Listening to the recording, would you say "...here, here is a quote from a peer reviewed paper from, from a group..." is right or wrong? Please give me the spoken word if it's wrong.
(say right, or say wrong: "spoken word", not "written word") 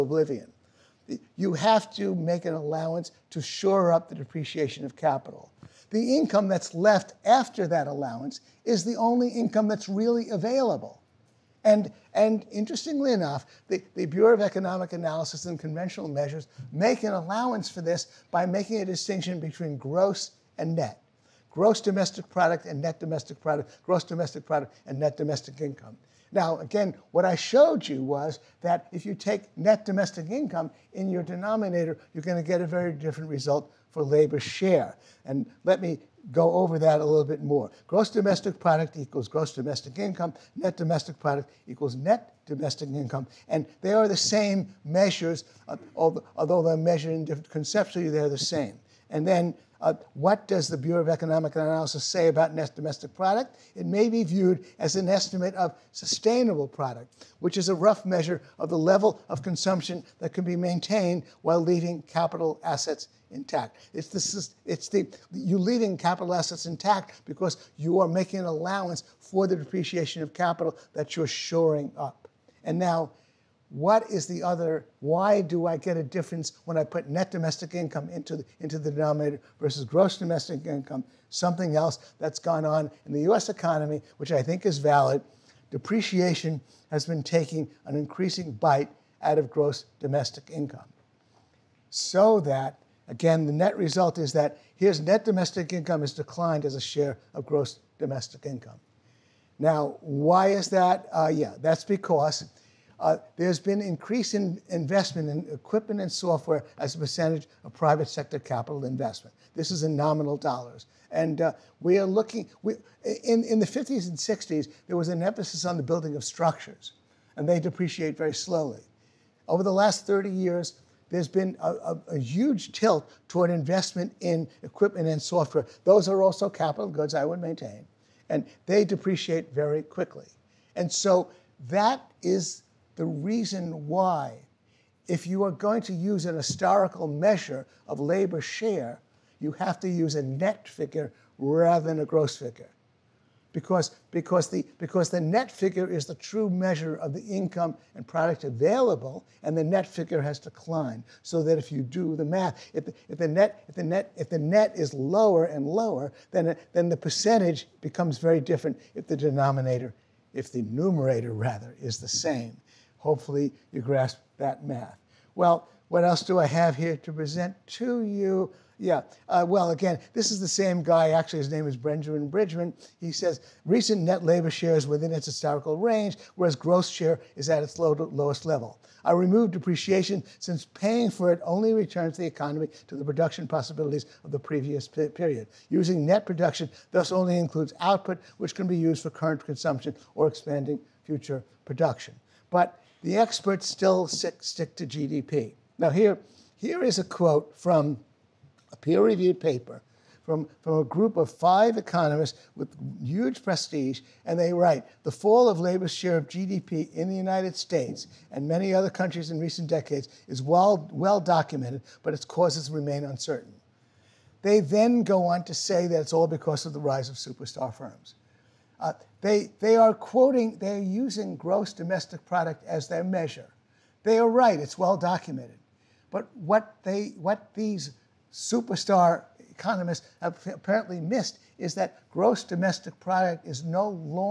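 right.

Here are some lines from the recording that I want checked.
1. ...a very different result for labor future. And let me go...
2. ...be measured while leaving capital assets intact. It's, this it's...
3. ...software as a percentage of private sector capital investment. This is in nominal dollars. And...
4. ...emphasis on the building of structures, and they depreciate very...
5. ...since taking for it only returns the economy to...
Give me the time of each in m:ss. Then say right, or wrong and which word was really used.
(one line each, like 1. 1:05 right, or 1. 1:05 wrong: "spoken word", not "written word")
1. 0:32 wrong: "share", not "future"
2. 1:00 wrong: "maintained", not "measured"
3. 1:46 right
4. 1:55 right
5. 3:00 wrong: "paying", not "taking".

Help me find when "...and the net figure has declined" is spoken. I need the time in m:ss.
2:29.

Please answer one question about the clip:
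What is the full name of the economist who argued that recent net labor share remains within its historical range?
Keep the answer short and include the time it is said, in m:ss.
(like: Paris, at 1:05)
Benjamin Bridgman, at 2:51.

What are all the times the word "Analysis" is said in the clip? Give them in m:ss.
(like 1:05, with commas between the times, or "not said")
0:14, 0:51.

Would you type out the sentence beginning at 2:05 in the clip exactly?
Those are also capital goods, I would maintain, and they depreciate very quickly.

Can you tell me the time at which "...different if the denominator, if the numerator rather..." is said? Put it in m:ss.
2:38.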